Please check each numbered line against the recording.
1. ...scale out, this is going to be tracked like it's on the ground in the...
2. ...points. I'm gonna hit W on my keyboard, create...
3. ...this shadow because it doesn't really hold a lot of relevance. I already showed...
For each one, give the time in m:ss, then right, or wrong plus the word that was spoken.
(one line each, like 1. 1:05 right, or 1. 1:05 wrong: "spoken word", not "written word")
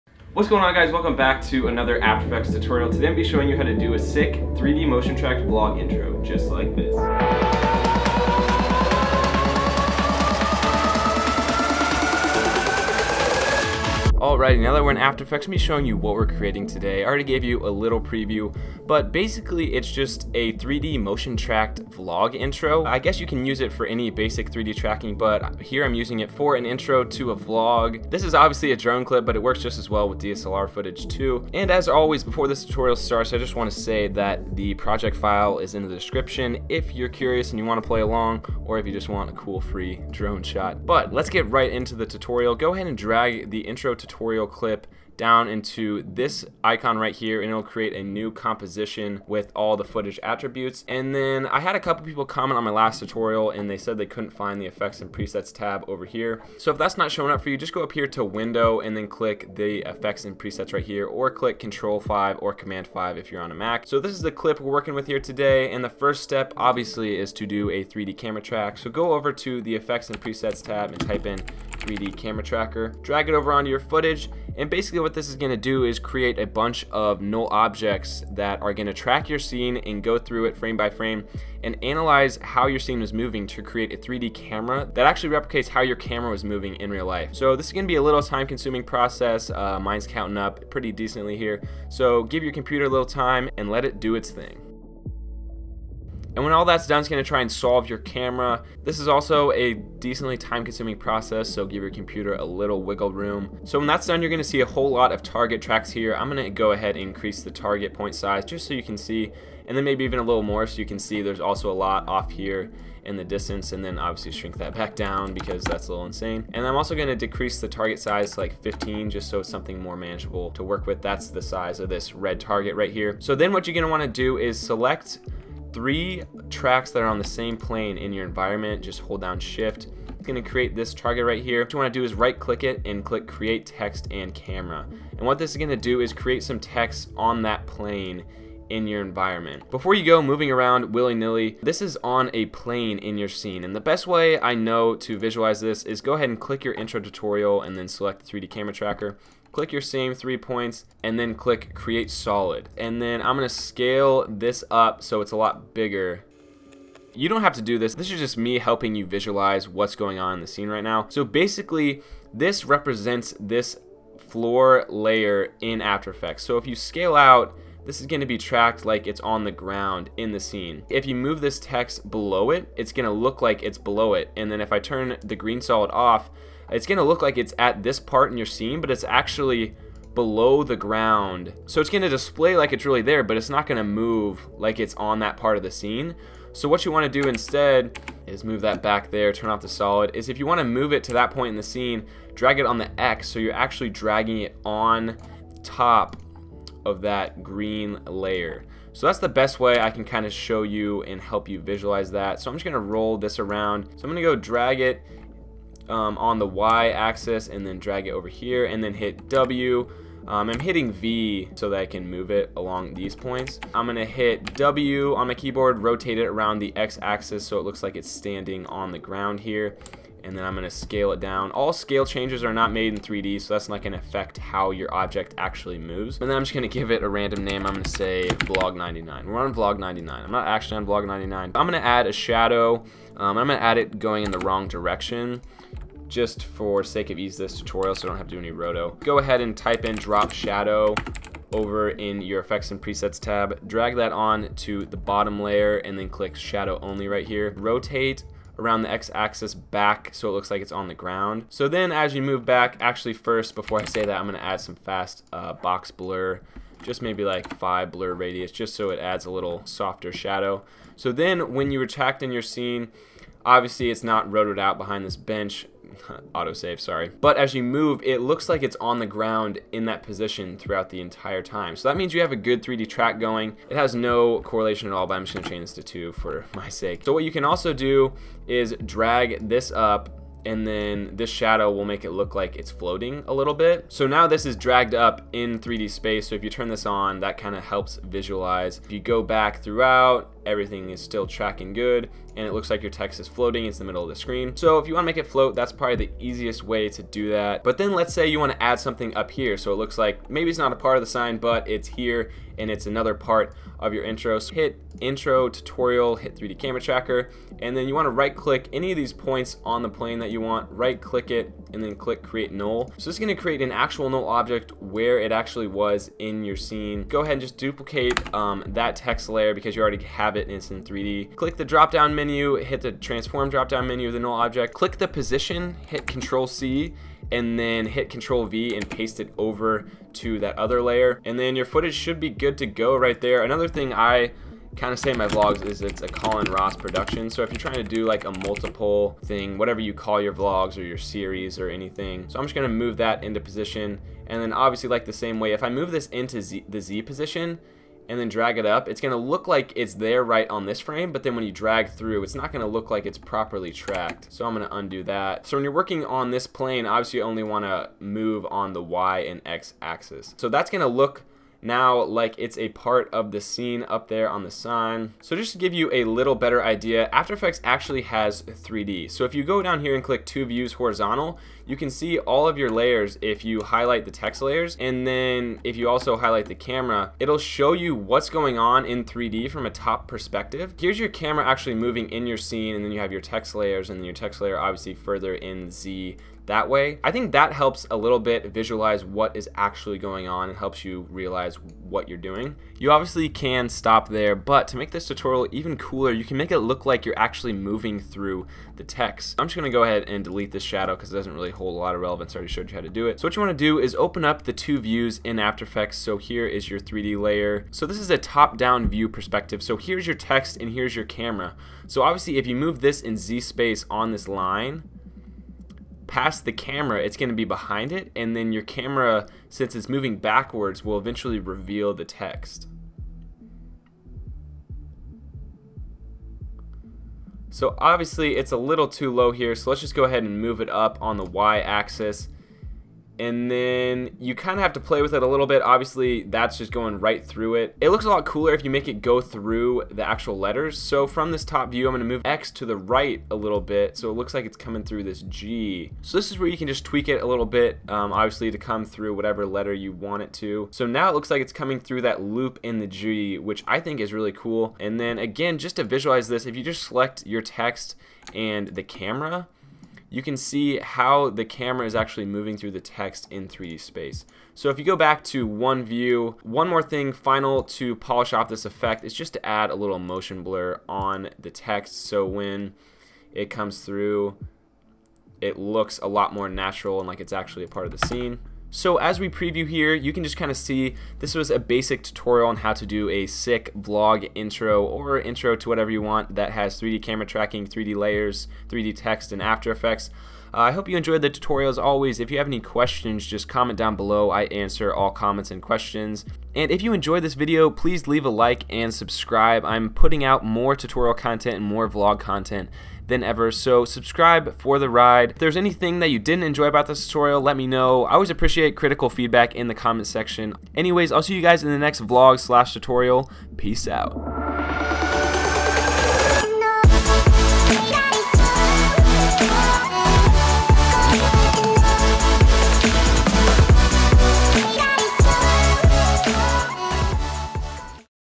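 1. 2:46 right
2. 3:33 wrong: "rotate", not "create"
3. 6:40 right.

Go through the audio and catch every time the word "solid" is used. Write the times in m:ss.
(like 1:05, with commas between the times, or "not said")
2:32, 2:55, 3:09.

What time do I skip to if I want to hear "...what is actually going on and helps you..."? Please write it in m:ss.
6:29.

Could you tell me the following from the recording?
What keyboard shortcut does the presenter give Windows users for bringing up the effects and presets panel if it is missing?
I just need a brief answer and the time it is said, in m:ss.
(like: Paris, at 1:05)
Control 5, at 1:01.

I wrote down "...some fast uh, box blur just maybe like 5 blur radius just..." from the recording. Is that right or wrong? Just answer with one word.
right.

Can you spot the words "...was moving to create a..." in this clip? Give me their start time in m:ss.
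1:23.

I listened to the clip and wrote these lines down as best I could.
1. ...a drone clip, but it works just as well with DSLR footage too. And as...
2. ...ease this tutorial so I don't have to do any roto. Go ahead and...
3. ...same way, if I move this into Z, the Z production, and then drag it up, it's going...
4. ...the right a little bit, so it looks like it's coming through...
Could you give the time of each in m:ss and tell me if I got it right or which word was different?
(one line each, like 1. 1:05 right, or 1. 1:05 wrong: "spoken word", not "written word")
1. 0:28 right
2. 3:57 right
3. 5:45 wrong: "position", not "production"
4. 7:22 right.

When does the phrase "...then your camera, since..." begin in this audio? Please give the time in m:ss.
6:58.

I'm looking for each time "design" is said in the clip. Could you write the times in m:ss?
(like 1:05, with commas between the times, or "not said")
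not said.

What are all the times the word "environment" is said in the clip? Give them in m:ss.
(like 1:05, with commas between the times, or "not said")
2:08, 2:19.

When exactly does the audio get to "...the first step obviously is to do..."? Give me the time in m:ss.
1:05.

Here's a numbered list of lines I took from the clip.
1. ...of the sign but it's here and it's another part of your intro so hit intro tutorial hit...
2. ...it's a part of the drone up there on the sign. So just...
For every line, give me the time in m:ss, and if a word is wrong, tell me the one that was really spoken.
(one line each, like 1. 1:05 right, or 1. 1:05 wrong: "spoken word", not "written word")
1. 5:00 right
2. 6:02 wrong: "scene", not "drone".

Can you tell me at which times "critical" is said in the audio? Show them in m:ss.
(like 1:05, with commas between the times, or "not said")
8:28.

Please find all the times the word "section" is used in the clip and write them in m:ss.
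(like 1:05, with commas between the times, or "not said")
8:30.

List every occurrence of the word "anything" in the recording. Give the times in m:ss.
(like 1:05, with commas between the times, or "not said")
5:41, 8:25.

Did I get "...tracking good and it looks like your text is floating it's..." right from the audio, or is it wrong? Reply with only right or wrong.
right.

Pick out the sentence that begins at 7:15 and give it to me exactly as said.
Obviously, that's just going right through it.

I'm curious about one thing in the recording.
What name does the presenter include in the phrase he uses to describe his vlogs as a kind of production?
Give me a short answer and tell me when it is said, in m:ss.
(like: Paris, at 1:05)
Colin Ross, at 5:36.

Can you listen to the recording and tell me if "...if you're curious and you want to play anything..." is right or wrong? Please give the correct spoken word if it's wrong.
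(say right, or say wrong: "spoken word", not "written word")
wrong: "along", not "anything".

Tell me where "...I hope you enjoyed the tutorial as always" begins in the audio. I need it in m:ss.
8:10.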